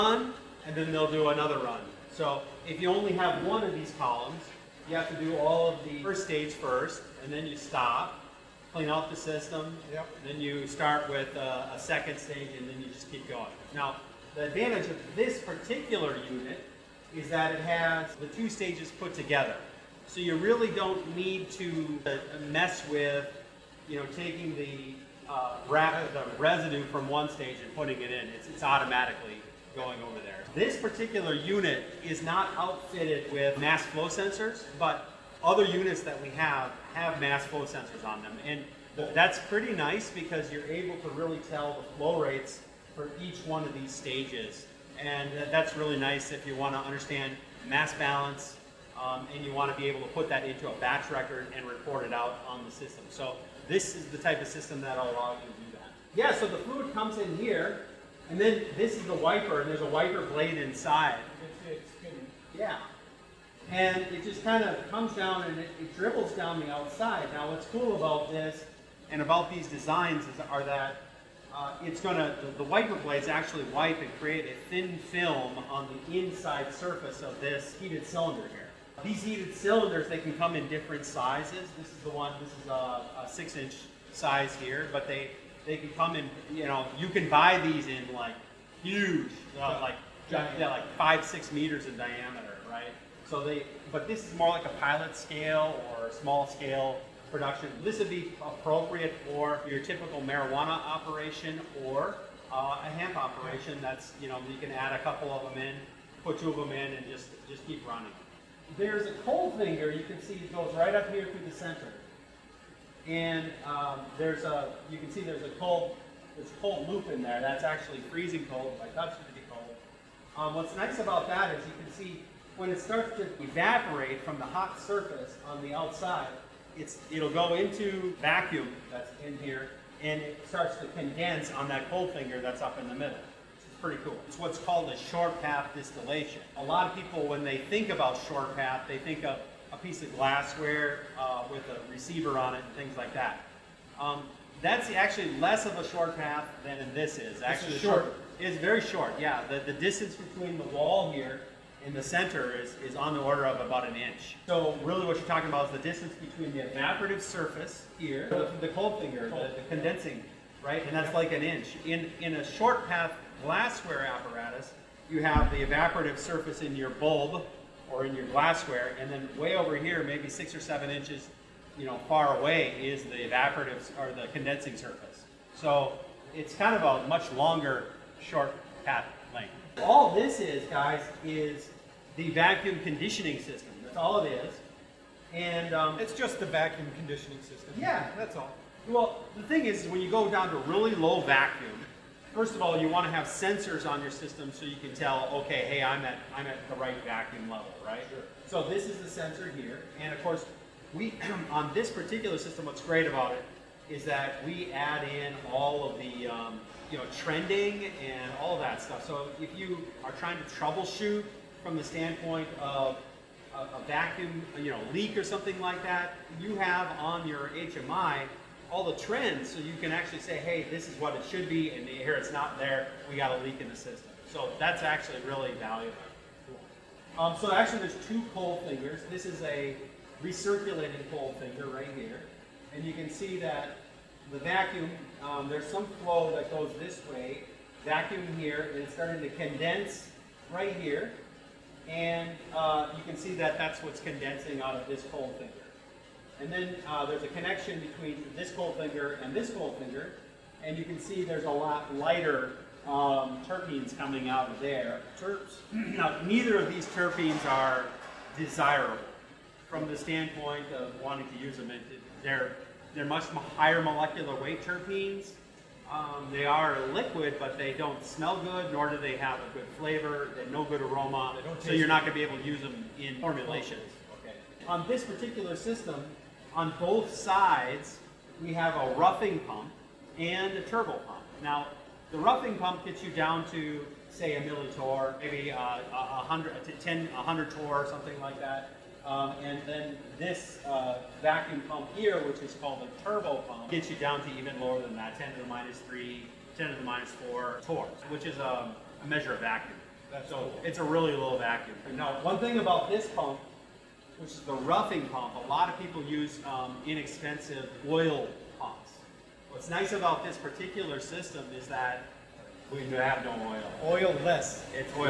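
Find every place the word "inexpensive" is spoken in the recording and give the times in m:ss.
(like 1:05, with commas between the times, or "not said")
5:06.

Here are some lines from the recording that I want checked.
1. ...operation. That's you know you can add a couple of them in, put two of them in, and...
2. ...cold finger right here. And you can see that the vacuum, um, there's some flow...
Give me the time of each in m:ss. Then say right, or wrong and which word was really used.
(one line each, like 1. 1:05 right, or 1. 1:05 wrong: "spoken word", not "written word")
1. 1:43 right
2. 3:51 right.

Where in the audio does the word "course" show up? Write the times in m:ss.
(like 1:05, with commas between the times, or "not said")
3:20.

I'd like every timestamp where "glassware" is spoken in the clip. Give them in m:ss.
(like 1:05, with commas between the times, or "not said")
2:20, 2:43, 2:48.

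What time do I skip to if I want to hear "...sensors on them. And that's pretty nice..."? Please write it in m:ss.
0:37.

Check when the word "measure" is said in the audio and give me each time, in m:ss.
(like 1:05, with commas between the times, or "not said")
4:59.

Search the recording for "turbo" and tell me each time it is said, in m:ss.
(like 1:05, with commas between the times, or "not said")
4:40, 4:53.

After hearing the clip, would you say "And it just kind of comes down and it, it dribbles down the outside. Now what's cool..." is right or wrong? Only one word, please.
right.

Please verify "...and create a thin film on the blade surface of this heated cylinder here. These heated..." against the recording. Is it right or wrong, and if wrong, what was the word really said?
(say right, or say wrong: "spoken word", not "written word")
wrong: "inside", not "blade".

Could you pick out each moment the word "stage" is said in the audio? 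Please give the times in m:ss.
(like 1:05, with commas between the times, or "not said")
0:06, 0:12, 0:18, 0:27, 0:43.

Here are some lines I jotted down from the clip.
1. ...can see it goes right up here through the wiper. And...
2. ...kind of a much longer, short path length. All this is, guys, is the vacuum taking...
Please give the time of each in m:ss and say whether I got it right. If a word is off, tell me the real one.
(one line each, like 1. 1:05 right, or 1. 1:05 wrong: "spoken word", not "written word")
1. 1:50 wrong: "center", not "wiper"
2. 2:56 wrong: "conditioning", not "taking".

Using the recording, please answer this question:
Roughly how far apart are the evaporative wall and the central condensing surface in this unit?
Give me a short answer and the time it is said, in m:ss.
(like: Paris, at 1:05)
about an inch, at 2:33.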